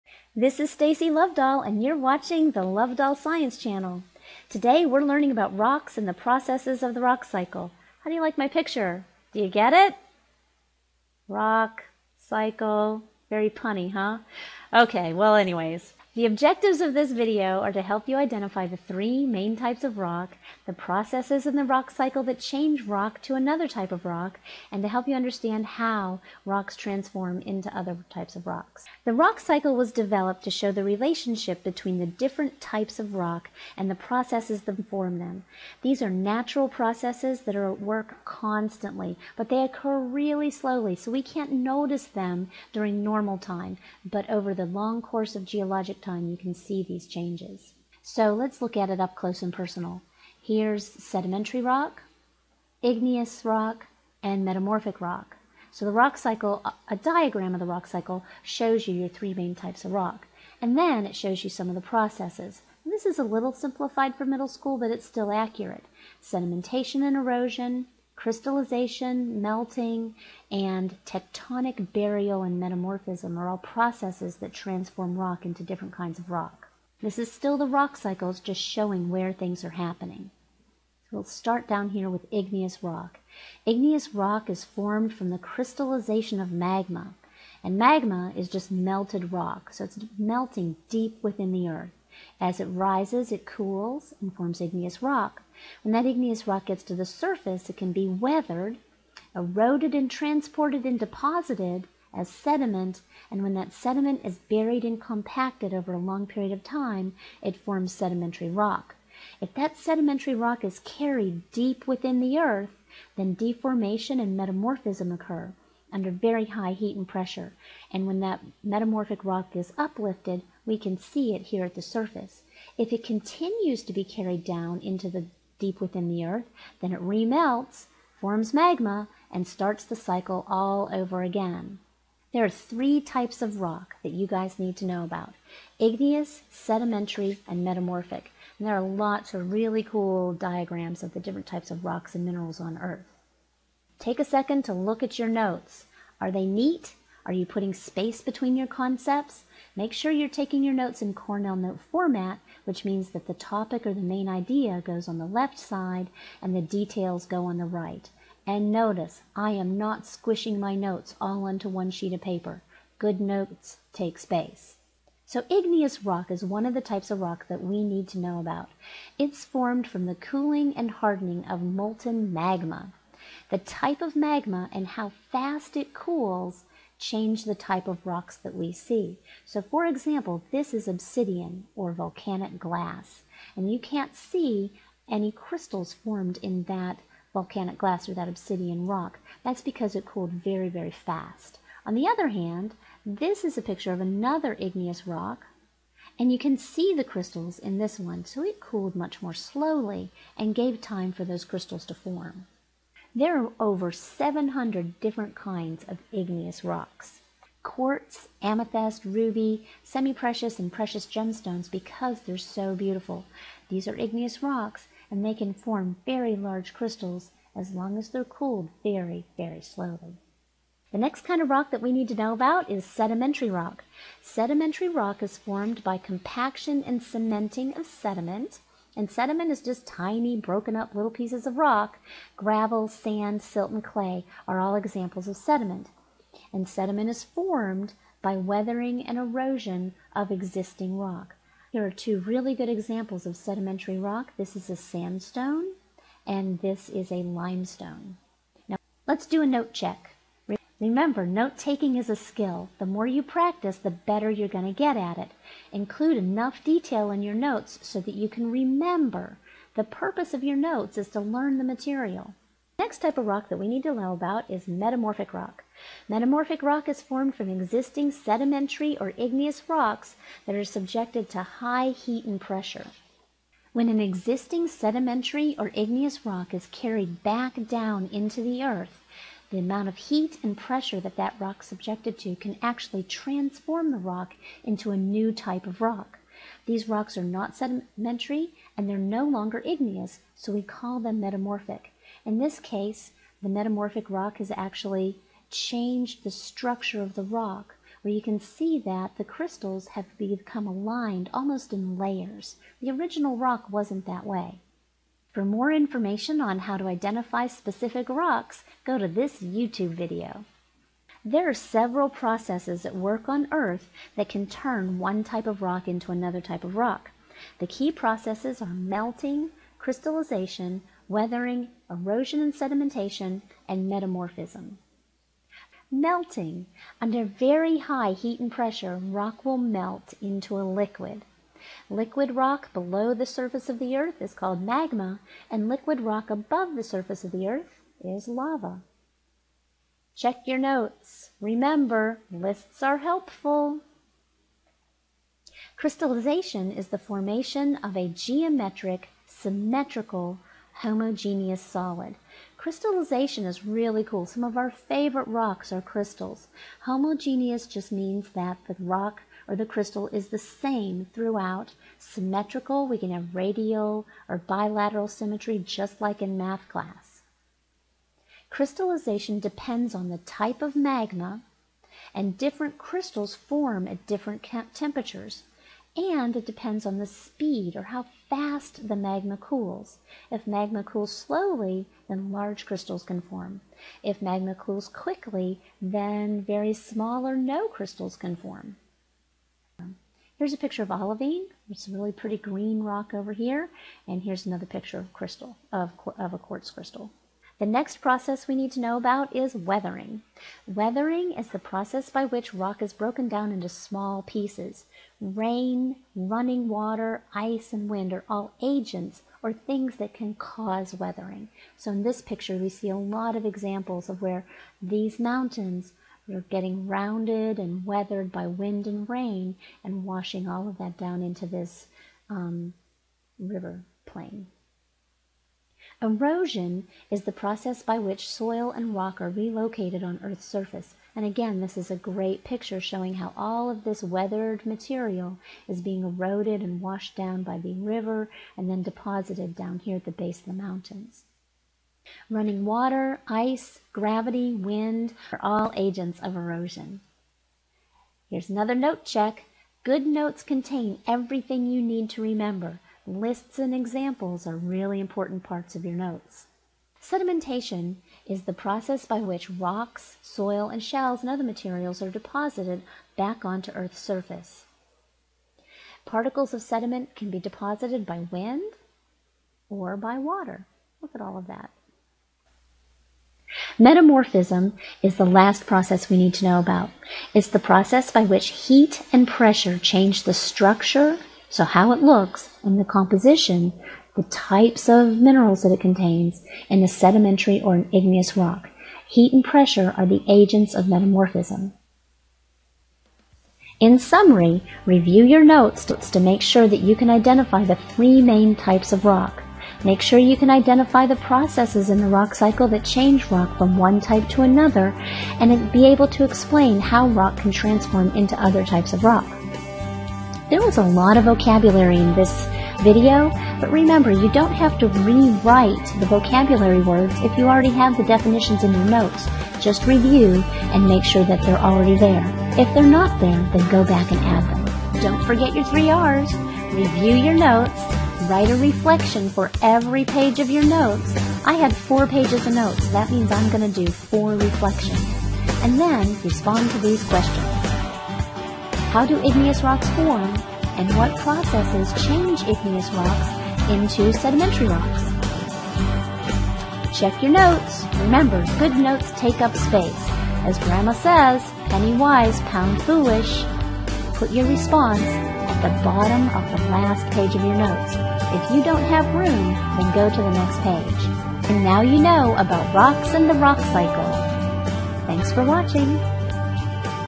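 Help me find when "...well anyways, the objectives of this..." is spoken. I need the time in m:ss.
0:15.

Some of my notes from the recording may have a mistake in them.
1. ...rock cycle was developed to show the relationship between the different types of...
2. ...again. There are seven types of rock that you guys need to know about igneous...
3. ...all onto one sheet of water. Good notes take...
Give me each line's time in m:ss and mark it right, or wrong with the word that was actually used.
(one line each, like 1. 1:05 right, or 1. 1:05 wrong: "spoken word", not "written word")
1. 0:29 right
2. 2:11 wrong: "three", not "seven"
3. 2:41 wrong: "paper", not "water".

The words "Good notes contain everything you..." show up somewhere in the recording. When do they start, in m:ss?
7:29.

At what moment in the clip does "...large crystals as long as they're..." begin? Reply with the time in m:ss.
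3:36.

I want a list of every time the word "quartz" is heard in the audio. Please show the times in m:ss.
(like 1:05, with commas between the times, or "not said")
3:27, 6:36.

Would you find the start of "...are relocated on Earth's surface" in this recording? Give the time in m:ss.
7:09.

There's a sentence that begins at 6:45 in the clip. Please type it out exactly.
Rain, running water, ice, and wind are all agents or things that can cause weathering.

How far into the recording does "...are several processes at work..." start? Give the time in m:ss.
5:11.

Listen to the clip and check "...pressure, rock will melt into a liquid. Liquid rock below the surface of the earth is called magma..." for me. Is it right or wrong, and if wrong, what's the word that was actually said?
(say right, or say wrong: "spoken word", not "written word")
right.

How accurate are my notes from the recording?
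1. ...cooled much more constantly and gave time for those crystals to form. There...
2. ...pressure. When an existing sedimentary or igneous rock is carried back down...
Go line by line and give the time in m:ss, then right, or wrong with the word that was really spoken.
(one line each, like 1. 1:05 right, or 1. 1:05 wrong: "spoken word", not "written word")
1. 3:18 wrong: "slowly", not "constantly"
2. 4:32 right.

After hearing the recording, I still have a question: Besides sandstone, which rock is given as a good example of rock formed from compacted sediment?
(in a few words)
limestone.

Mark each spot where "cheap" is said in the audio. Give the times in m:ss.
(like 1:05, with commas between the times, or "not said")
not said.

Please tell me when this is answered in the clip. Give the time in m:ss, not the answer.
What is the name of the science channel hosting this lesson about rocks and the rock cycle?
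0:02.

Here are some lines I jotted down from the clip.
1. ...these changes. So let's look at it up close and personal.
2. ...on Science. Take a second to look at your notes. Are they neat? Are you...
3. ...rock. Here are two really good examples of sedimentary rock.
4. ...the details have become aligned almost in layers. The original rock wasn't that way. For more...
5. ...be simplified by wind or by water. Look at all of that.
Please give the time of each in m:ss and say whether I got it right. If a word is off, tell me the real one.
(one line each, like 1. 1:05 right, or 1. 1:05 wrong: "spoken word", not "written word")
1. 0:46 right
2. 2:22 wrong: "Earth", not "Science"
3. 4:00 right
4. 4:59 wrong: "crystals", not "details"
5. 7:47 wrong: "deposited", not "simplified".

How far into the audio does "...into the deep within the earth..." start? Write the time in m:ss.
2:04.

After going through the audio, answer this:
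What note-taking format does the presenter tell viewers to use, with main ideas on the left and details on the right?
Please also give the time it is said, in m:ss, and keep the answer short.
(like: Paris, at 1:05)
Cornell note format, at 2:31.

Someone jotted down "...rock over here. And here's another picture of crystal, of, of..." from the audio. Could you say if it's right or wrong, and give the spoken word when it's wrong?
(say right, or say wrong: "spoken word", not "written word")
right.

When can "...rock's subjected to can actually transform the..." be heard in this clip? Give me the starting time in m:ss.
4:41.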